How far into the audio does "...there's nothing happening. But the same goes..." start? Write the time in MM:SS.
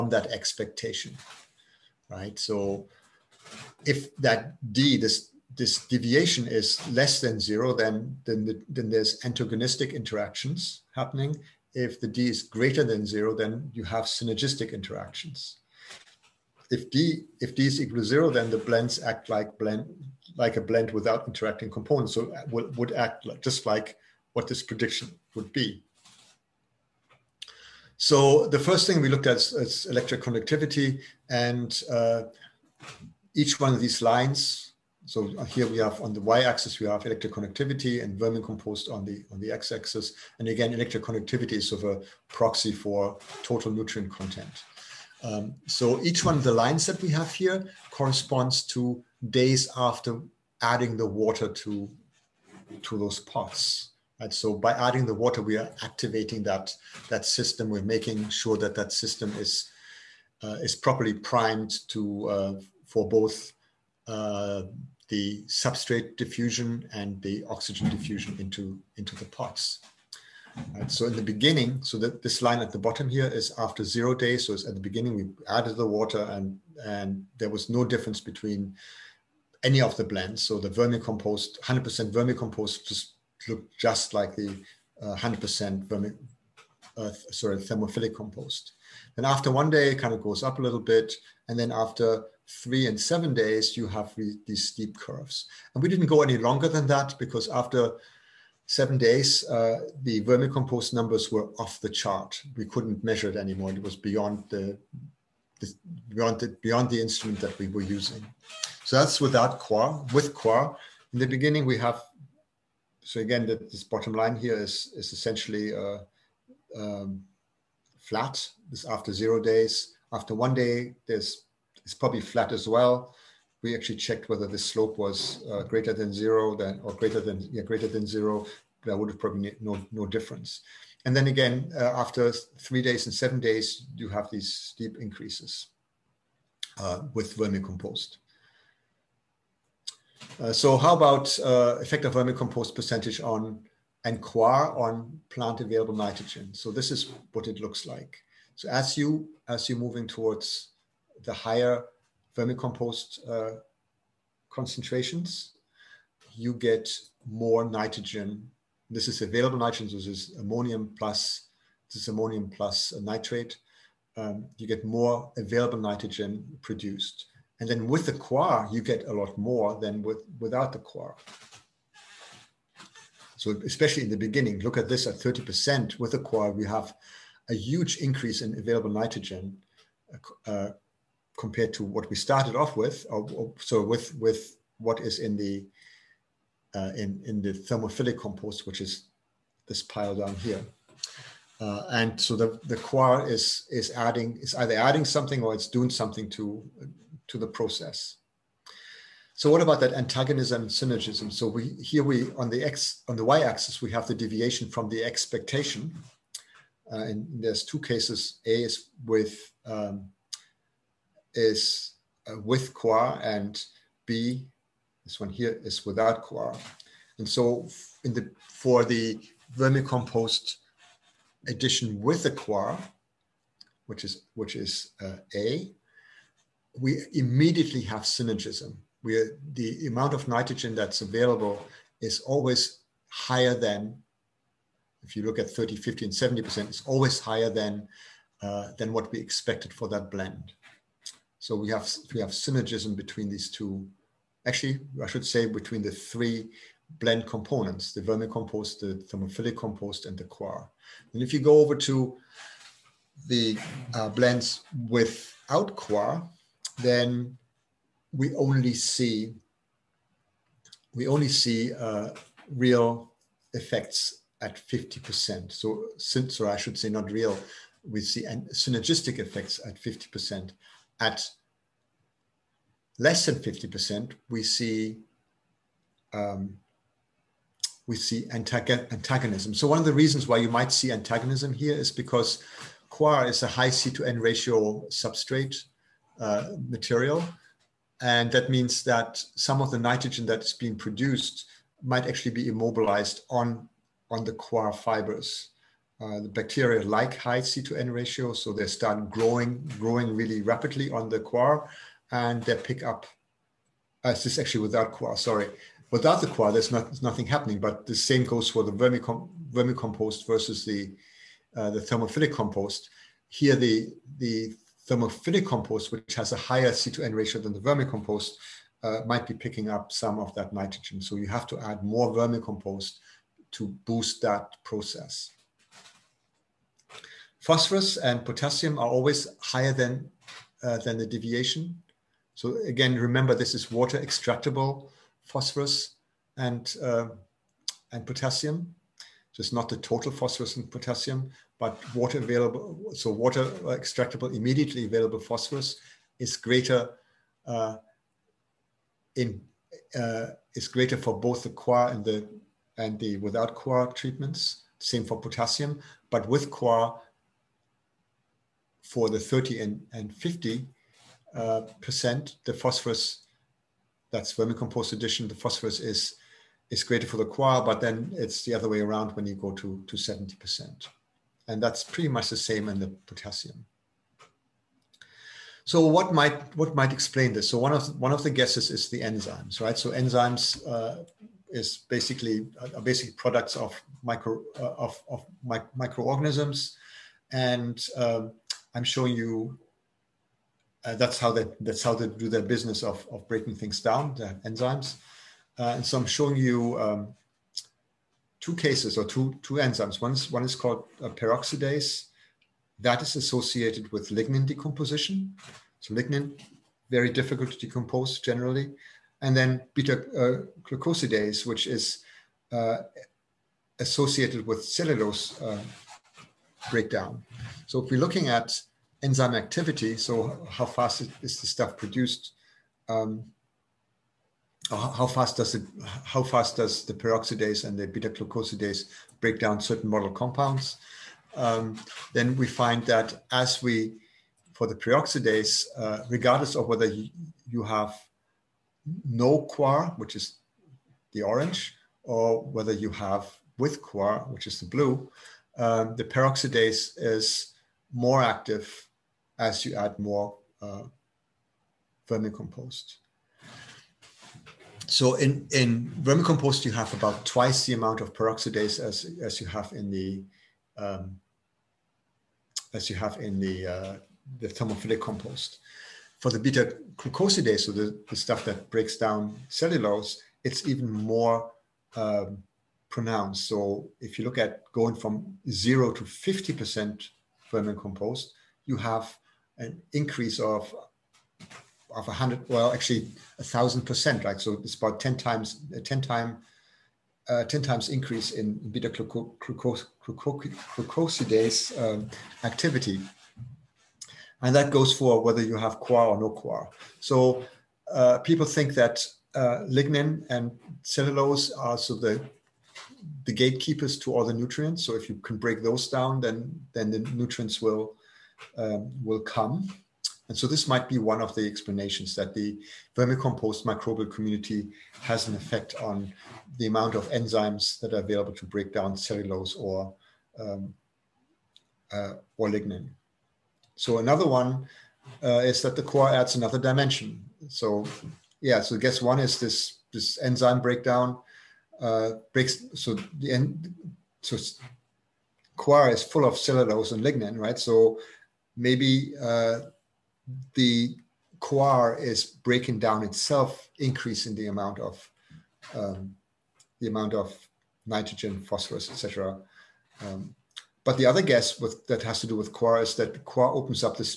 05:06.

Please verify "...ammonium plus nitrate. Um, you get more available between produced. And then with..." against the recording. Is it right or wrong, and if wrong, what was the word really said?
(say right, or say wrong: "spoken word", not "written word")
wrong: "nitrogen", not "between".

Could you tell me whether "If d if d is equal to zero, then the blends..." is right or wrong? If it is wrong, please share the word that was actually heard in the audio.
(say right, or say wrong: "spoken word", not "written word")
right.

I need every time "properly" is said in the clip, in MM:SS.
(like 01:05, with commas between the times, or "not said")
01:00.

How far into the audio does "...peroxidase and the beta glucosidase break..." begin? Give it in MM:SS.
07:06.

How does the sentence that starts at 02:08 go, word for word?
That would have probably no, no difference.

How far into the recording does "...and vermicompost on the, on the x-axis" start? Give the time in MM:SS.
00:38.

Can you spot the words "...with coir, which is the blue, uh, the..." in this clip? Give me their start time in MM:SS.
07:23.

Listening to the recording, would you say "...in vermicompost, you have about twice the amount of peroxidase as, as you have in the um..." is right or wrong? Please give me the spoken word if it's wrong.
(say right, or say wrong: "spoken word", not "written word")
right.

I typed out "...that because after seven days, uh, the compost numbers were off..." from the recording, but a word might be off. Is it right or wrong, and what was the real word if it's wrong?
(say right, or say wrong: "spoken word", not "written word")
wrong: "vermicompost", not "compost".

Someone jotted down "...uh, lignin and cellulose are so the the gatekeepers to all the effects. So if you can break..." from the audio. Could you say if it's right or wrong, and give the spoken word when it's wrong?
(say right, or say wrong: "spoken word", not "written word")
wrong: "nutrients", not "effects".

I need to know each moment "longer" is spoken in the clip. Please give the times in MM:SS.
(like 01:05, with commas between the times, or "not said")
01:36.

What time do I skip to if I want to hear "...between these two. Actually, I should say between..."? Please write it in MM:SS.
04:02.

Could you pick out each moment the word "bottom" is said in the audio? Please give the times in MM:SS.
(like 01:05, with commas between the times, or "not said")
01:12, 01:53.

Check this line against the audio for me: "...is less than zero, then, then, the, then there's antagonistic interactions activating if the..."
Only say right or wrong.
wrong.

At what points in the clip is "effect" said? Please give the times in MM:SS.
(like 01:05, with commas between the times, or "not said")
02:21, 04:23, 04:29, 08:35.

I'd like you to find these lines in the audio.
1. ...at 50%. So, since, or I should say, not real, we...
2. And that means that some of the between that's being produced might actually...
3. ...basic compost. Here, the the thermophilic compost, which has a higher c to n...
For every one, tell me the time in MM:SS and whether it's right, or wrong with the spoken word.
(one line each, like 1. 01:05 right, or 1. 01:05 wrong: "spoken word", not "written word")
1. 04:24 right
2. 04:48 wrong: "nitrogen", not "between"
3. 05:11 wrong: "thermophilic", not "basic".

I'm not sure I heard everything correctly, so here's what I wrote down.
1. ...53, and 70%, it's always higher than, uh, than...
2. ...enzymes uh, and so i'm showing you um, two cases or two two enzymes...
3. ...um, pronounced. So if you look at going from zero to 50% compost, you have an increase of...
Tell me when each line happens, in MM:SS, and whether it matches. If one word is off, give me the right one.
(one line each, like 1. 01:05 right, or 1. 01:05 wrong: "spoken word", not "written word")
1. 03:55 wrong: "50", not "53"
2. 06:34 right
3. 07:51 wrong: "vermicompost", not "compost".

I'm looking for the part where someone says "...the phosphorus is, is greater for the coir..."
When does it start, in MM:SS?
06:05.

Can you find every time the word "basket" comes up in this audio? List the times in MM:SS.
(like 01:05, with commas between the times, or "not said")
not said.